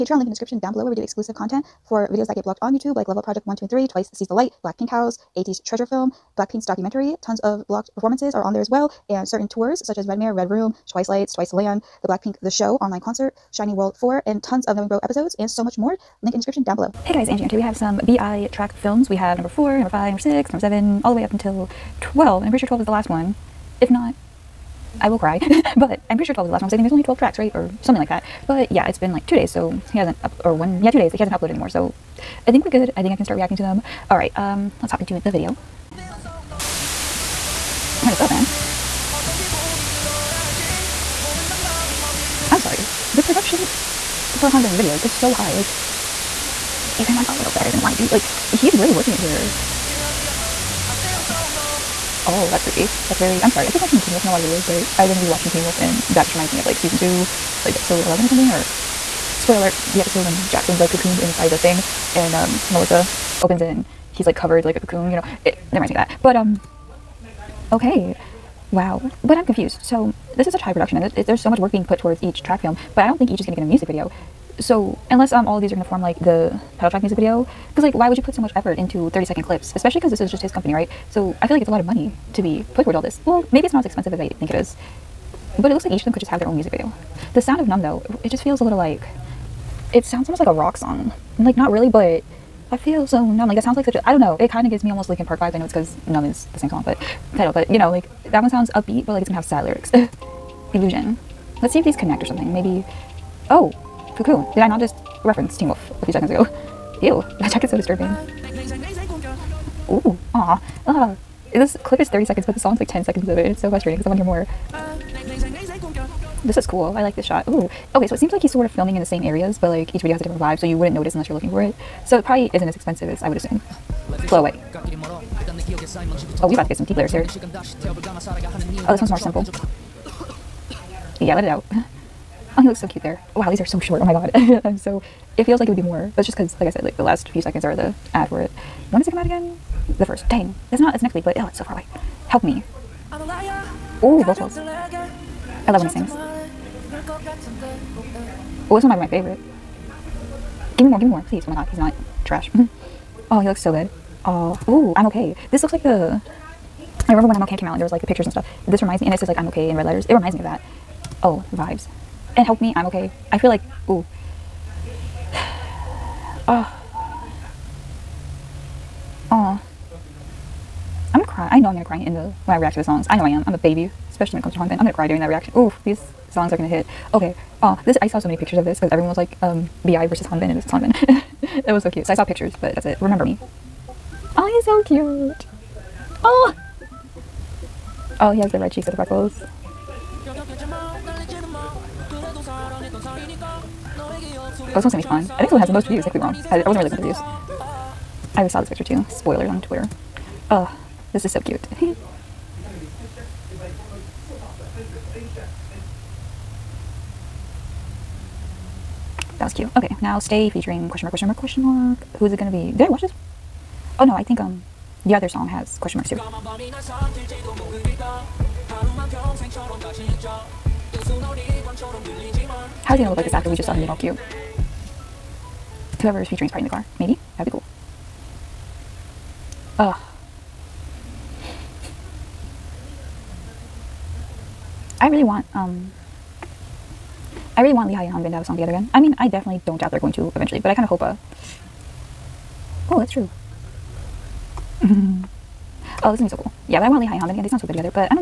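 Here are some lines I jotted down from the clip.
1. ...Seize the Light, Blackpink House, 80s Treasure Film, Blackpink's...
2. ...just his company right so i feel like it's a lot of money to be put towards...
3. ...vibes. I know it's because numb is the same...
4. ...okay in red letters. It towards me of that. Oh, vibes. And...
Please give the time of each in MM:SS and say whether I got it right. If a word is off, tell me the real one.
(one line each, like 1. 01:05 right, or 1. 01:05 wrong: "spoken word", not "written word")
1. 00:04 right
2. 01:20 right
3. 01:35 right
4. 02:39 wrong: "reminds", not "towards".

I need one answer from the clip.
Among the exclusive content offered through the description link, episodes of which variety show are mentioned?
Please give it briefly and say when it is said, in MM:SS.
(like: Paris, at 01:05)
Knowing Bro, at 00:14.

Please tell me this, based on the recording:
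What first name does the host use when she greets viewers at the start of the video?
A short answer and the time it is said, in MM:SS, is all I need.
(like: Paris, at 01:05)
Angie, at 00:17.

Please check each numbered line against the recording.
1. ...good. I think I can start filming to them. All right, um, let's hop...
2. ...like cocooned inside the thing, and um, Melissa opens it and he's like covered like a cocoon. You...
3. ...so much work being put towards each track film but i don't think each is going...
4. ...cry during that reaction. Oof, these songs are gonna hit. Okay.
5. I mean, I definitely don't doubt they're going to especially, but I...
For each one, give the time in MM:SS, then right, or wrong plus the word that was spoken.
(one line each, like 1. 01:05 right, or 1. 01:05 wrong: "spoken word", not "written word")
1. 00:32 wrong: "reacting", not "filming"
2. 01:00 right
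3. 01:11 right
4. 02:54 right
5. 03:58 wrong: "eventually", not "especially".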